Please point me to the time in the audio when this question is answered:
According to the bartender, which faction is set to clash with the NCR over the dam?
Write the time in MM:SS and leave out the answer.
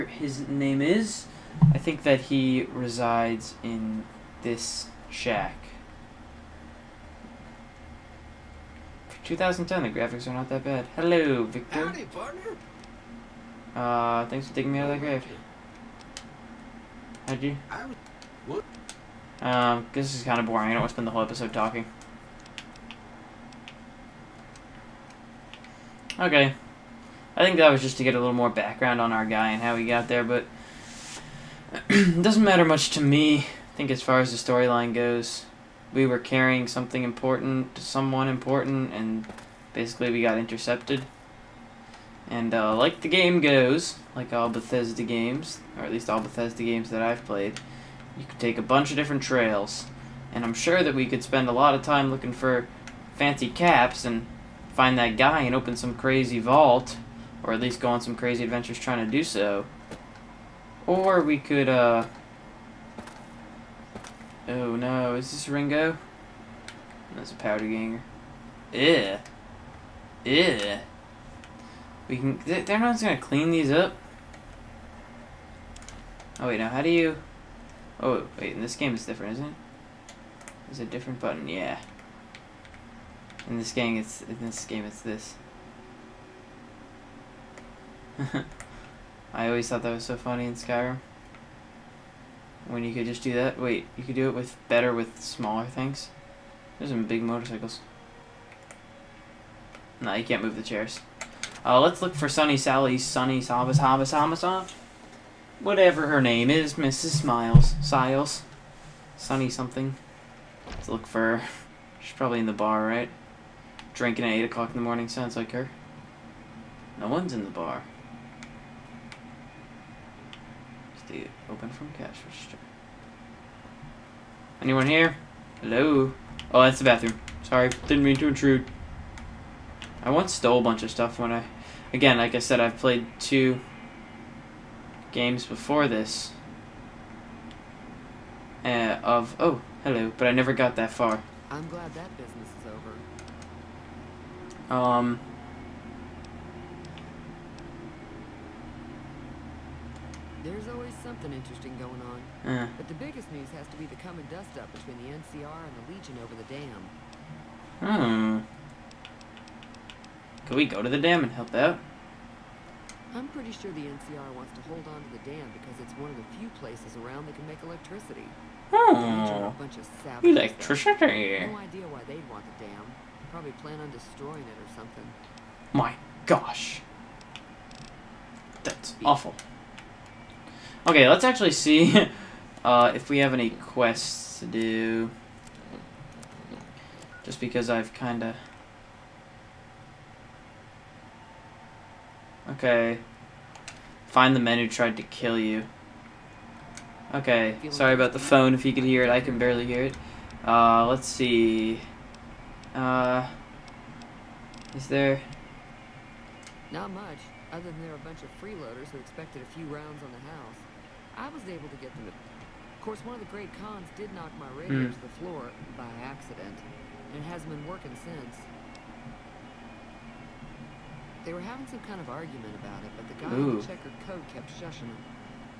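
02:35.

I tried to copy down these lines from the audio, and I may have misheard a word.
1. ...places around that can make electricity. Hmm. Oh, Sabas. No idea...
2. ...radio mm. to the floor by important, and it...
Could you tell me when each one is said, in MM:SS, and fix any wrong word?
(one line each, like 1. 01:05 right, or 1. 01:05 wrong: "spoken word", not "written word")
1. 02:46 wrong: "Electricity", not "Sabas"
2. 03:34 wrong: "accident", not "important".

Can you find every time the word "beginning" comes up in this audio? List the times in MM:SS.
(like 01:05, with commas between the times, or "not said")
not said.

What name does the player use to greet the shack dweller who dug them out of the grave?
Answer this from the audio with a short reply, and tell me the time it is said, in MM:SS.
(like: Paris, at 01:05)
Victor, at 00:11.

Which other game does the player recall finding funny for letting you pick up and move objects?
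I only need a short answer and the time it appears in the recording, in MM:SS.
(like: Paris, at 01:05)
Skyrim, at 01:30.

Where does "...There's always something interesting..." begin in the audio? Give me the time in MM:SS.
02:30.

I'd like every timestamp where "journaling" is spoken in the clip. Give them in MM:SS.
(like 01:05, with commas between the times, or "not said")
not said.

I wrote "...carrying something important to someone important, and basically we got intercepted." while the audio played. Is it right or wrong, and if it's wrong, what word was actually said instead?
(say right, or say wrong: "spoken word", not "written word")
right.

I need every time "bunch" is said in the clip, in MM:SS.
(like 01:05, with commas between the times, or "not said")
00:48, 02:10, 03:28.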